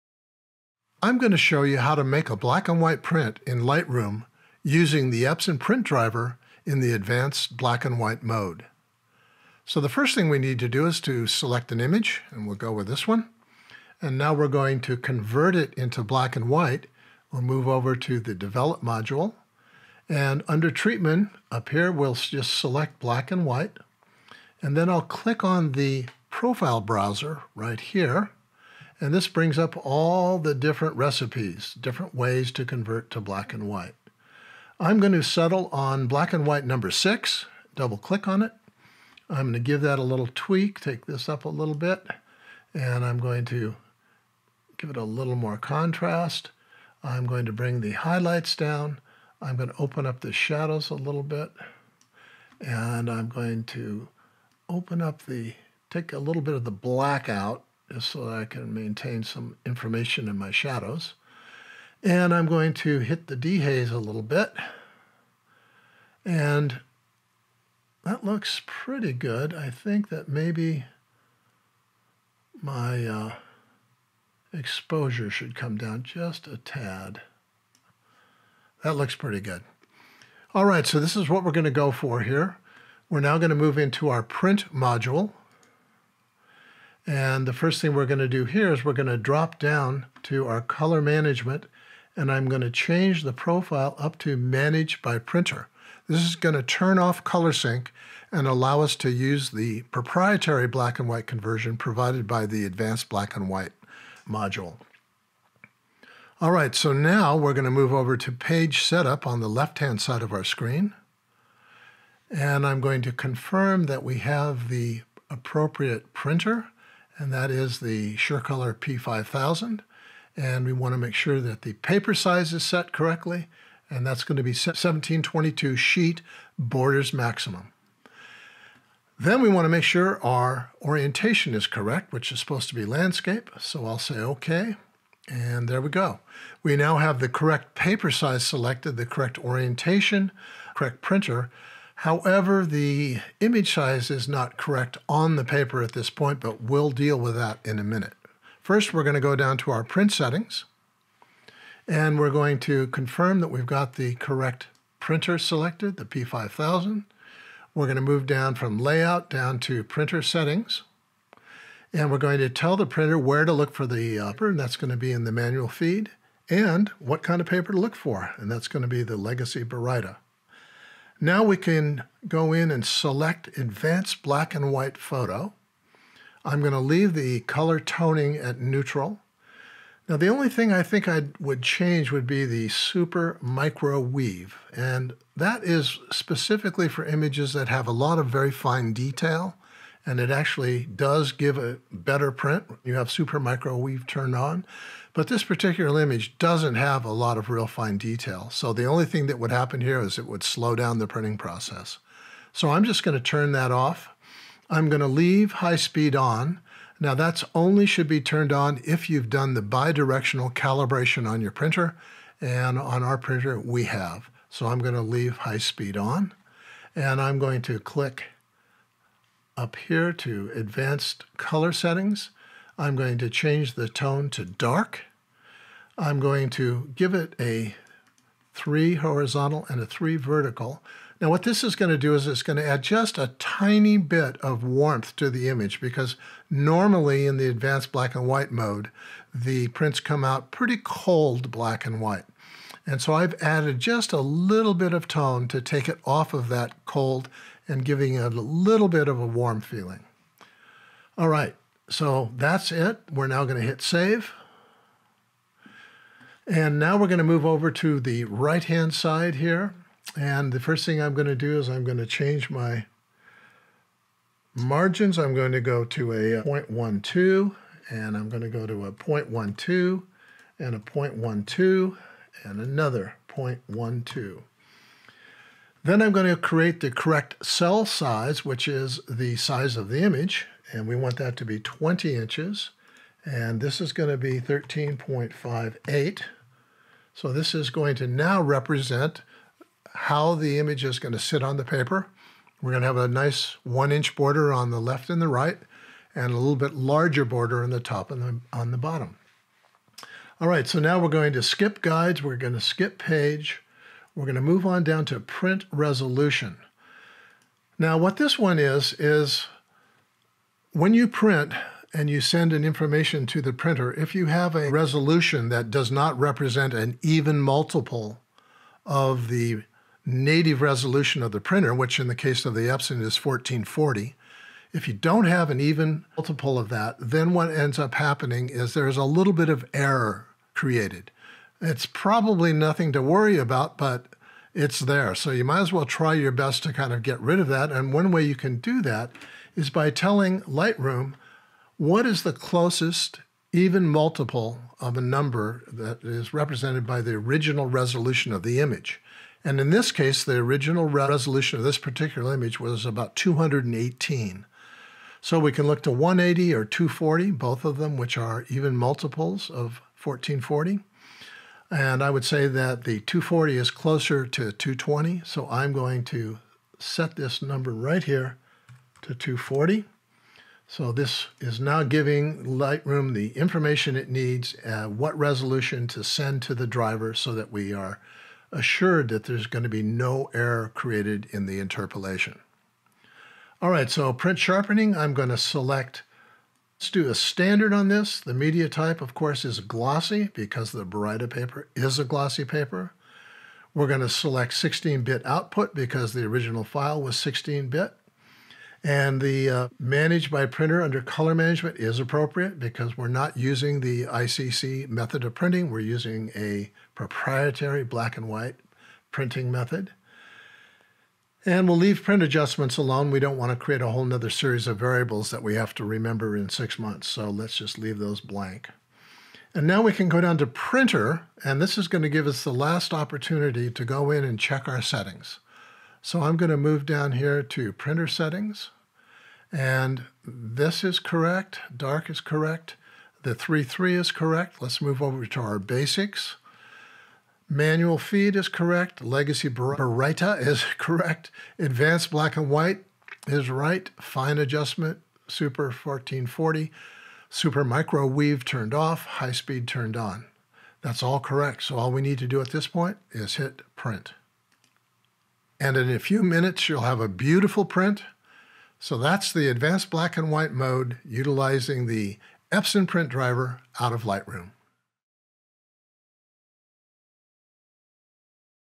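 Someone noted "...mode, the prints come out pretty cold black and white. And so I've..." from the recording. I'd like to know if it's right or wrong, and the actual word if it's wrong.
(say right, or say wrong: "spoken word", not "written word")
right.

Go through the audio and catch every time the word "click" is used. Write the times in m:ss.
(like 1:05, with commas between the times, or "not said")
0:25, 0:37, 3:37.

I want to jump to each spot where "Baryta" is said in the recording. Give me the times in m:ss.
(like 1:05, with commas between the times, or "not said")
2:49, 6:30, 7:19.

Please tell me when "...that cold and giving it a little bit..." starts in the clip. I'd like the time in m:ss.
4:06.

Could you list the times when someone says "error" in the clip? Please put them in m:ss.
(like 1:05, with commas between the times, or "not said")
5:29, 6:20.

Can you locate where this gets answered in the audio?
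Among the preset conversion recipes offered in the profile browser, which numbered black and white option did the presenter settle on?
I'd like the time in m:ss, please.
0:36.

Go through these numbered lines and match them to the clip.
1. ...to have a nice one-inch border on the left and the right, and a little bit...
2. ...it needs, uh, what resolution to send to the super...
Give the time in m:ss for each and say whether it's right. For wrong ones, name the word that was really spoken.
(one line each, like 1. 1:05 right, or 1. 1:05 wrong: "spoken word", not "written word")
1. 4:52 right
2. 6:13 wrong: "driver", not "super".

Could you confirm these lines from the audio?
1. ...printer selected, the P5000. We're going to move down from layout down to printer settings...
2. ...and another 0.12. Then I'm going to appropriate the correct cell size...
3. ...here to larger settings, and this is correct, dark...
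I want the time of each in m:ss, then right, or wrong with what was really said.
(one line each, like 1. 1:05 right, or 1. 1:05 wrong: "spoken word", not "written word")
1. 2:34 right
2. 4:32 wrong: "create", not "appropriate"
3. 7:07 wrong: "printer", not "larger".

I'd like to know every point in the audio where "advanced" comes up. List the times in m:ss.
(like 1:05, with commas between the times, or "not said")
0:06, 1:42, 2:53, 3:40, 3:57, 7:21, 7:39.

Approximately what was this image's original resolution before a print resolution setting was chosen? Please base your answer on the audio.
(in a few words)
218.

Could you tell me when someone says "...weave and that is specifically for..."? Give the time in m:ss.
3:03.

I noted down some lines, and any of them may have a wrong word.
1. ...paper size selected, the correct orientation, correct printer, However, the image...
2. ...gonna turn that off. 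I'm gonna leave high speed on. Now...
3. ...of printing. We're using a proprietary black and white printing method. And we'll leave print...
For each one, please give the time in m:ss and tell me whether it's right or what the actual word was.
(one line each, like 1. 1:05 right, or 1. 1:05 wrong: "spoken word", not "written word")
1. 2:17 right
2. 3:23 right
3. 6:45 right.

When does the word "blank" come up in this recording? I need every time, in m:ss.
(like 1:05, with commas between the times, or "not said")
6:58.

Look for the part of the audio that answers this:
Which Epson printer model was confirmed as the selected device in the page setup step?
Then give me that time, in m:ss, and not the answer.
1:58.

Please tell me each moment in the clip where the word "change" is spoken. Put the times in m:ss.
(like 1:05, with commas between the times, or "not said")
1:32, 3:01, 3:43, 4:22.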